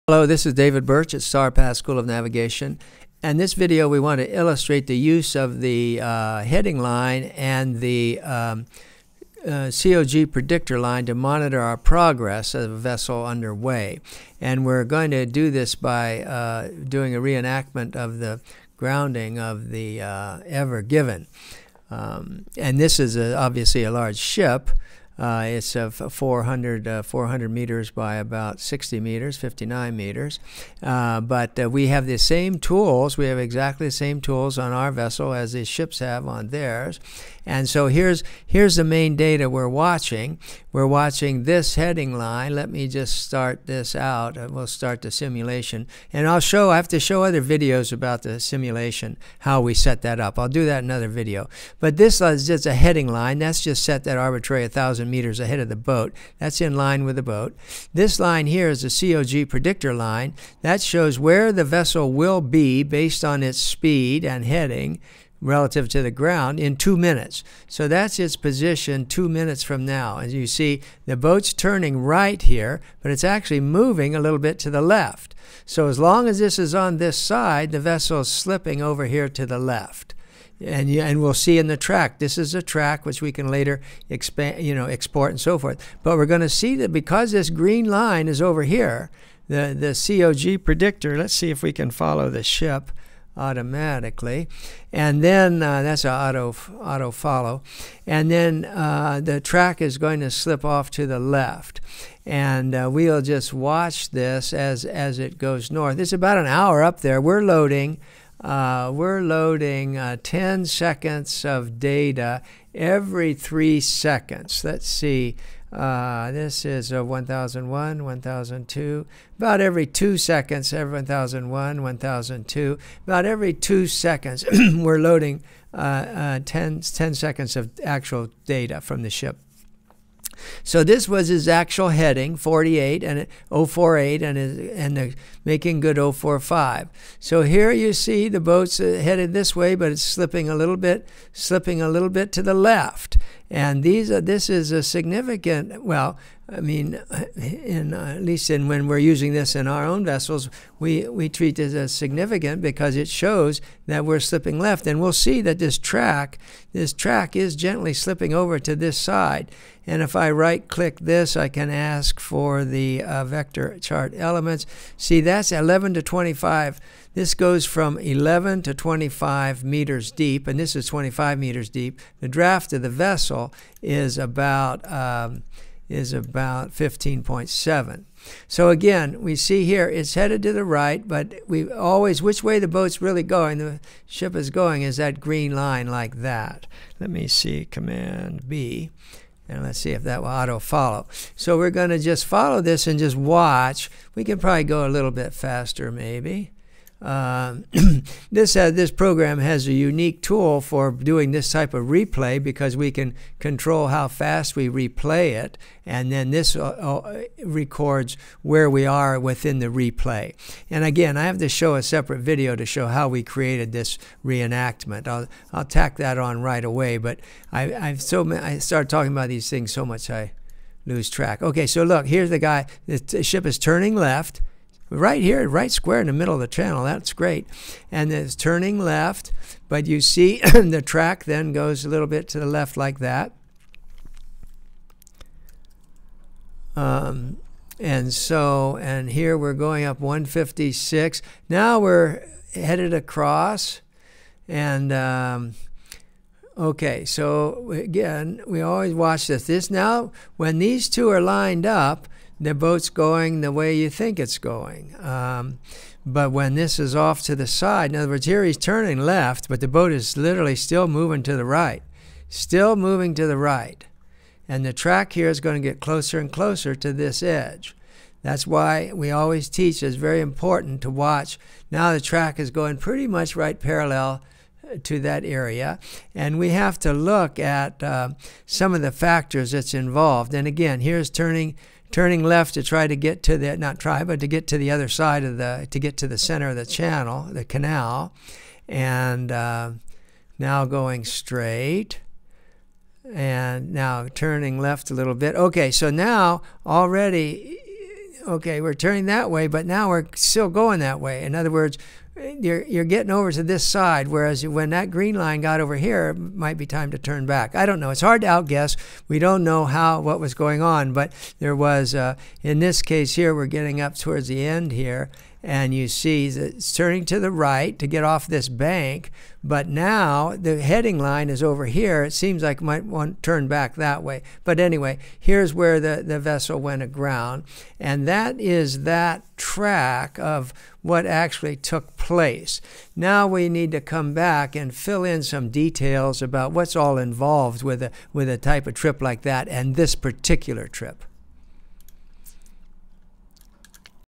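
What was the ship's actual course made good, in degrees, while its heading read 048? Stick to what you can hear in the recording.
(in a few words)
045.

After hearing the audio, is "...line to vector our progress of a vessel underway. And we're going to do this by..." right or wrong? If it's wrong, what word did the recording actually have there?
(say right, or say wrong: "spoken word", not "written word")
wrong: "monitor", not "vector".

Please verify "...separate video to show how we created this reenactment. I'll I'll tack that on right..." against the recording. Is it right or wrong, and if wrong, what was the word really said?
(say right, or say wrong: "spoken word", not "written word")
right.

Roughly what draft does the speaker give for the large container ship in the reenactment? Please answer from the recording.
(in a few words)
15.7.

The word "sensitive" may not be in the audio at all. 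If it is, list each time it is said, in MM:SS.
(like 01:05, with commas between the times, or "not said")
not said.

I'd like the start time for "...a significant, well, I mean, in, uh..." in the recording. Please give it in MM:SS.
02:24.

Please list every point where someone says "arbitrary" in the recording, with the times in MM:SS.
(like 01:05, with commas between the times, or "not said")
00:54.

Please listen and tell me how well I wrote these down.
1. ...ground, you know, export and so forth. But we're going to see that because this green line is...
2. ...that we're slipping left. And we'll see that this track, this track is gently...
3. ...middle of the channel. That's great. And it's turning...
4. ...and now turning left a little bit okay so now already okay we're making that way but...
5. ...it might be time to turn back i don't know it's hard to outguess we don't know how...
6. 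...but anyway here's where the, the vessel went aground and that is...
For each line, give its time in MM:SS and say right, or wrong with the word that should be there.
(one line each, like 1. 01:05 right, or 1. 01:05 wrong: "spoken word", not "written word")
1. 01:24 wrong: "expand", not "ground"
2. 02:33 right
3. 03:46 right
4. 04:53 wrong: "turning", not "making"
5. 05:06 right
6. 05:24 right.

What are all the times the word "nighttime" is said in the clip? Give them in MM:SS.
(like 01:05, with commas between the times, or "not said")
not said.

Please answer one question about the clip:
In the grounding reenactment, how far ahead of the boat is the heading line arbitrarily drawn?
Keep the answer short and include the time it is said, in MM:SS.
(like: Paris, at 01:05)
1,000 meters, at 00:54.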